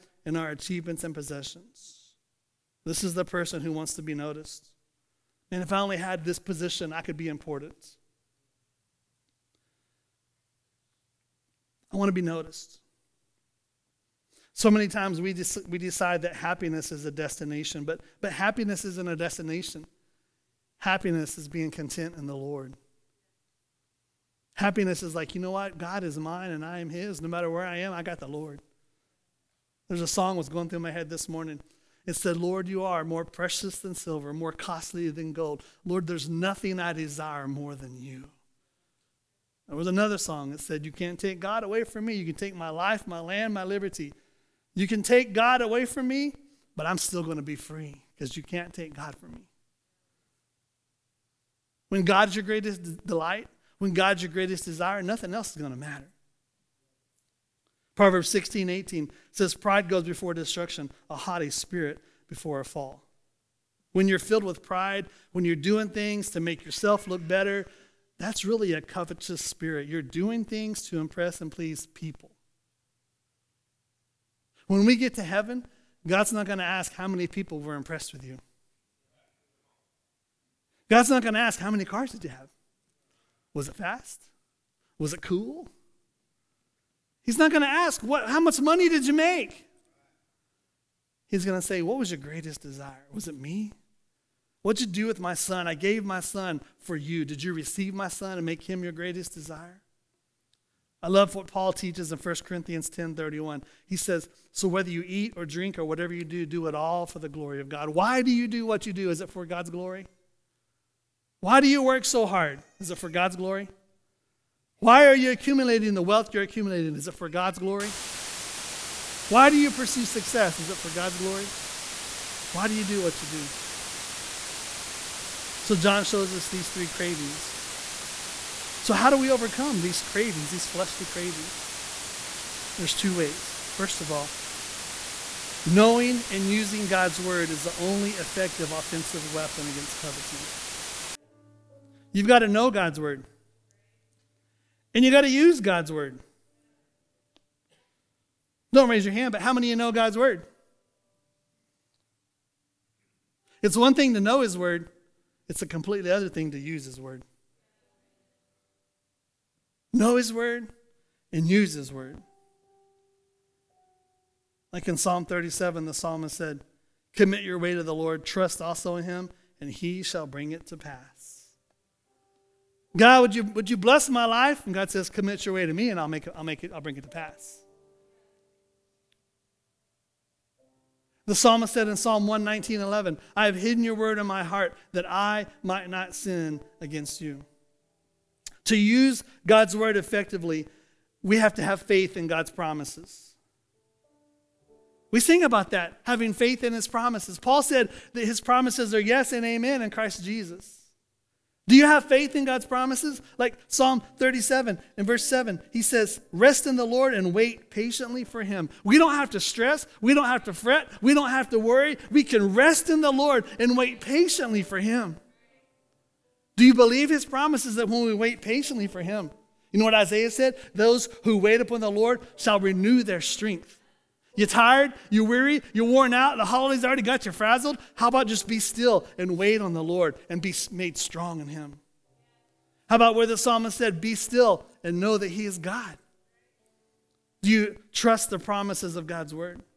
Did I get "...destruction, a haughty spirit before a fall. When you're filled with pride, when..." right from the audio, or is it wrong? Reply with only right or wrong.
right.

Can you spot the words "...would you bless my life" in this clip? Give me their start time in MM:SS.
02:53.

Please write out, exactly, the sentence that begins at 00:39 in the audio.
There was another song that said, You can't take God away from me.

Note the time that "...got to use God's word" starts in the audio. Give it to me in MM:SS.
02:25.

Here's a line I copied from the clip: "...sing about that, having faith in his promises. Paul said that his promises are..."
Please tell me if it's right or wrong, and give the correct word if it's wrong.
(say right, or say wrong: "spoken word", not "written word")
right.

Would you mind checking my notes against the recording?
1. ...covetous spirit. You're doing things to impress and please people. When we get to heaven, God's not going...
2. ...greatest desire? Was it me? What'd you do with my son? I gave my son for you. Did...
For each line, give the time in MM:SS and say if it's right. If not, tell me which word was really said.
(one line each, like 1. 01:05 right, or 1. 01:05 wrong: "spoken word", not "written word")
1. 01:08 right
2. 01:32 right.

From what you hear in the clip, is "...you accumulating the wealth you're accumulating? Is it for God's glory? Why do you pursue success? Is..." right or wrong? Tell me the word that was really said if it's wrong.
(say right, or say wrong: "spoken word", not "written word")
right.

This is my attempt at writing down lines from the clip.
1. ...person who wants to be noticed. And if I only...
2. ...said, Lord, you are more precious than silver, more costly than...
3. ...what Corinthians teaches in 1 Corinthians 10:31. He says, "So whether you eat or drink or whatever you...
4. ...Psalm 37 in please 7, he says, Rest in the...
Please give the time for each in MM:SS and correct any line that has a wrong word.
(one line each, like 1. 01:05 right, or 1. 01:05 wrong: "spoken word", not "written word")
1. 00:03 right
2. 00:32 right
3. 01:41 wrong: "Paul", not "Corinthians"
4. 03:23 wrong: "verse", not "please".